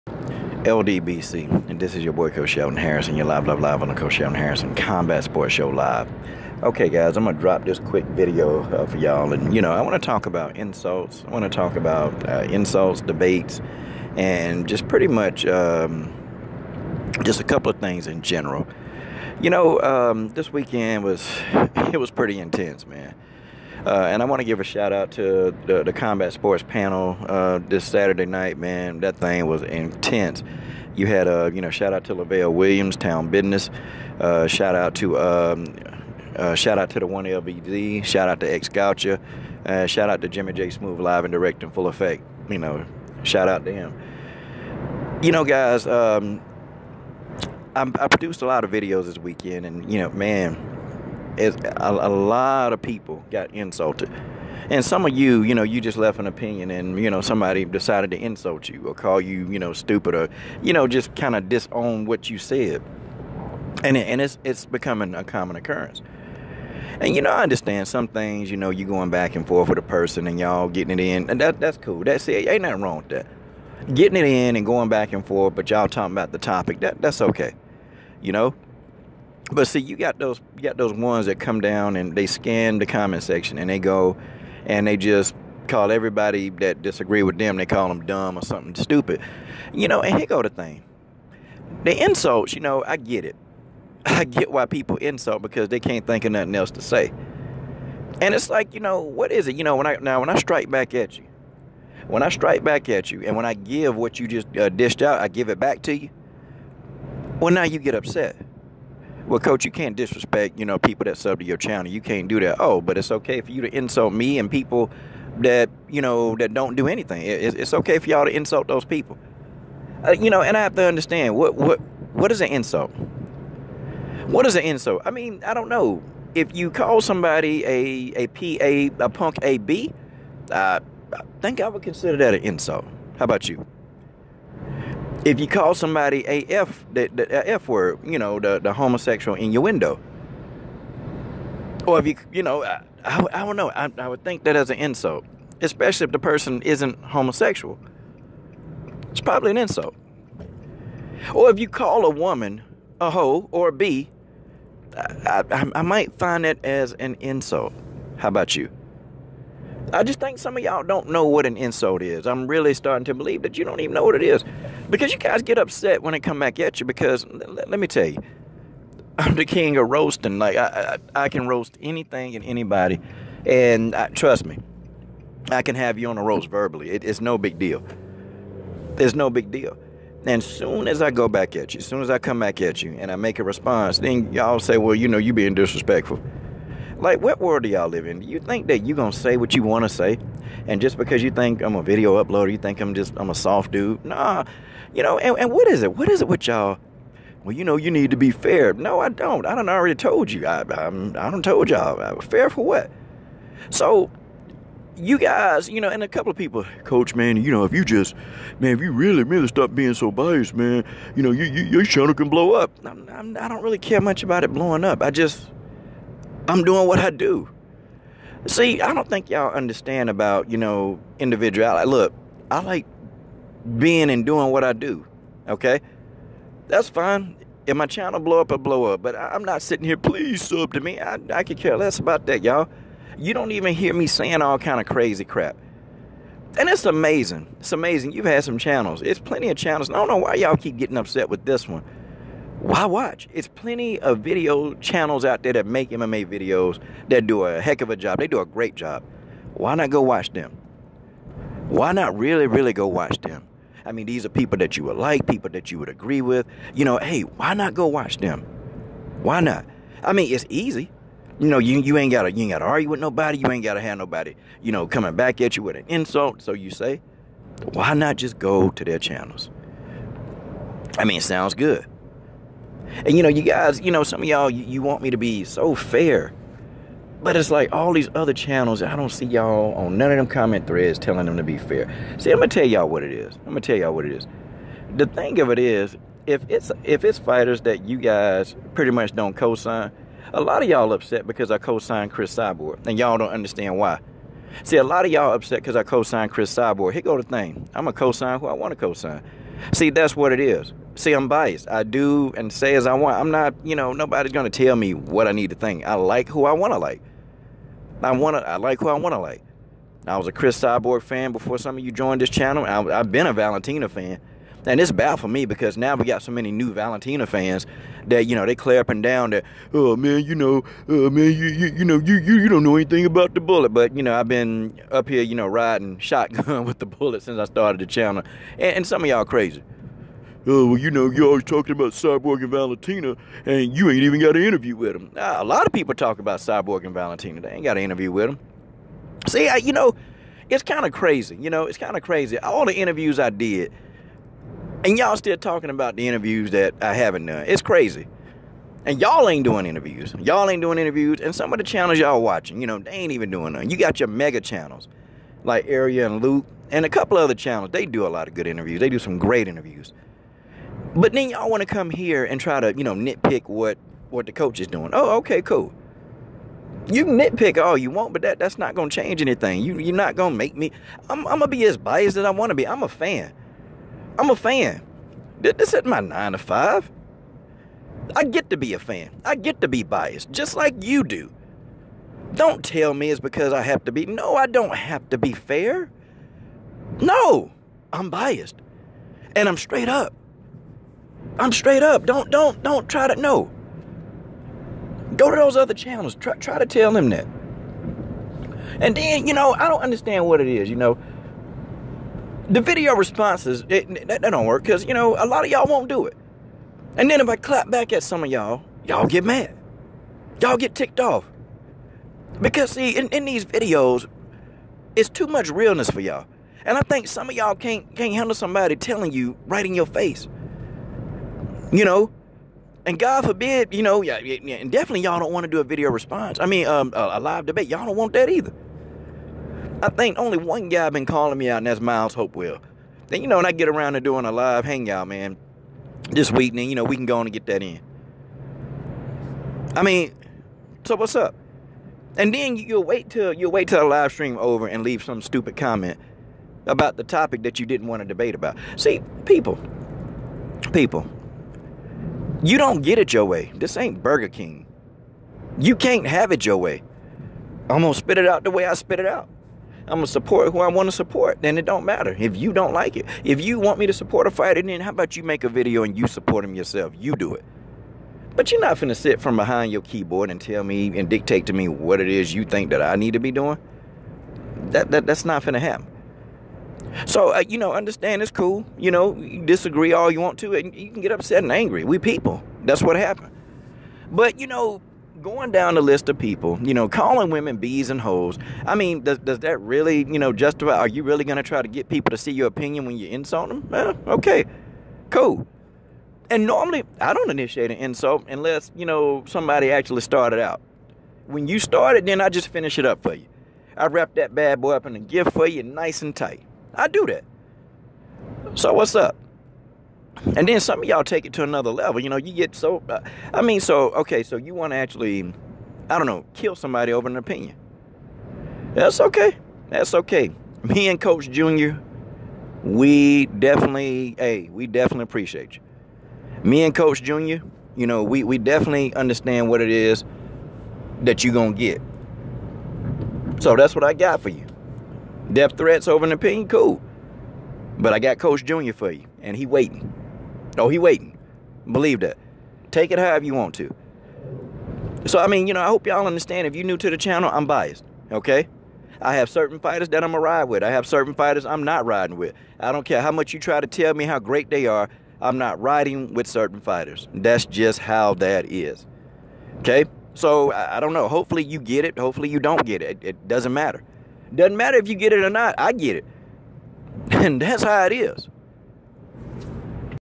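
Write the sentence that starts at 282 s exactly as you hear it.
See, I'm gonna tell y'all what it is.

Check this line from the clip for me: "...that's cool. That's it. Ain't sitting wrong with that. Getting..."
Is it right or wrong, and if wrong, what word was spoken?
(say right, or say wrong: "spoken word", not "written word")
wrong: "nothing", not "sitting".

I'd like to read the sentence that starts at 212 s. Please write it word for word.
I'm, I'm, I do not really care much about it blowing up.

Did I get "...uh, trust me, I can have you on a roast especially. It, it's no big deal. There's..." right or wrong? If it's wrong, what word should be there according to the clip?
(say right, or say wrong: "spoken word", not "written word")
wrong: "verbally", not "especially".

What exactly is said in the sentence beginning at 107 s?
Well, now you get upset well, coach, you can't disrespect, you know, people that sub to your channel.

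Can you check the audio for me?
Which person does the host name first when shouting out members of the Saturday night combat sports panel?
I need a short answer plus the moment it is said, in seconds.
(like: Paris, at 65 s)
Lavelle Williams, at 32 s.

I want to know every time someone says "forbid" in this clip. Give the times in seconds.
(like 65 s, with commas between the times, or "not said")
423 s.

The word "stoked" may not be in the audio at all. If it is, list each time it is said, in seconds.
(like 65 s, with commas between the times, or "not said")
not said.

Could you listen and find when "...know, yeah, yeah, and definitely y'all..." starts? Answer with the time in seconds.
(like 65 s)
423 s.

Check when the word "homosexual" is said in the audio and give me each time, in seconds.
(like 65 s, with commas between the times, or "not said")
138 s, 147 s.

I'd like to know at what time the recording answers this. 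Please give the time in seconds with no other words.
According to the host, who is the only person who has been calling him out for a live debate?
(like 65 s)
431 s.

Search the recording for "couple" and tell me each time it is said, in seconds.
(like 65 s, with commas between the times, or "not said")
17 s, 206 s, 356 s.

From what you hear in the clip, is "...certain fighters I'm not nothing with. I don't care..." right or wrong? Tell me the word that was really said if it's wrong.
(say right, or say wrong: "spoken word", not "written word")
wrong: "riding", not "nothing".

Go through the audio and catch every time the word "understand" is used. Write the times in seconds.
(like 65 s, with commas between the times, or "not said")
67 s, 120 s, 219 s, 293 s, 399 s, 477 s, 528 s, 546 s.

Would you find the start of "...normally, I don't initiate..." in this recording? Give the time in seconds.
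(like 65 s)
496 s.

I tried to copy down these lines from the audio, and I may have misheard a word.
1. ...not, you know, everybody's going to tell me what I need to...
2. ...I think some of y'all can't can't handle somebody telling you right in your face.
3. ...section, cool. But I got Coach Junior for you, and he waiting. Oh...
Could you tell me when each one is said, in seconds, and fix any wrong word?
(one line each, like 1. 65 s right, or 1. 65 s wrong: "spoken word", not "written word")
1. 303 s wrong: "nobody", not "everybody"
2. 416 s right
3. 536 s wrong: "opinion", not "section".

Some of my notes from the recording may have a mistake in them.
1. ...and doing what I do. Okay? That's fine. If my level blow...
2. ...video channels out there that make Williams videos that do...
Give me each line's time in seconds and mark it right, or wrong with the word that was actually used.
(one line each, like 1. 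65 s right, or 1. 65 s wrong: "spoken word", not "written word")
1. 224 s wrong: "channel", not "level"
2. 244 s wrong: "MMA", not "Williams".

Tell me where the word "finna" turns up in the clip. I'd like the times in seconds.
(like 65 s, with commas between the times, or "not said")
468 s, 475 s.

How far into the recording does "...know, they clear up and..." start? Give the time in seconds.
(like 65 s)
318 s.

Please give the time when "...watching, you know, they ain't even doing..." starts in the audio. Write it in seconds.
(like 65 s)
352 s.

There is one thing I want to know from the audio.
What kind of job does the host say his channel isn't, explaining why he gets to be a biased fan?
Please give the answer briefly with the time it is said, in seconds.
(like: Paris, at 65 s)
nine to five, at 376 s.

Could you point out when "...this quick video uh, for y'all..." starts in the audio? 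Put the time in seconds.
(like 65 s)
7 s.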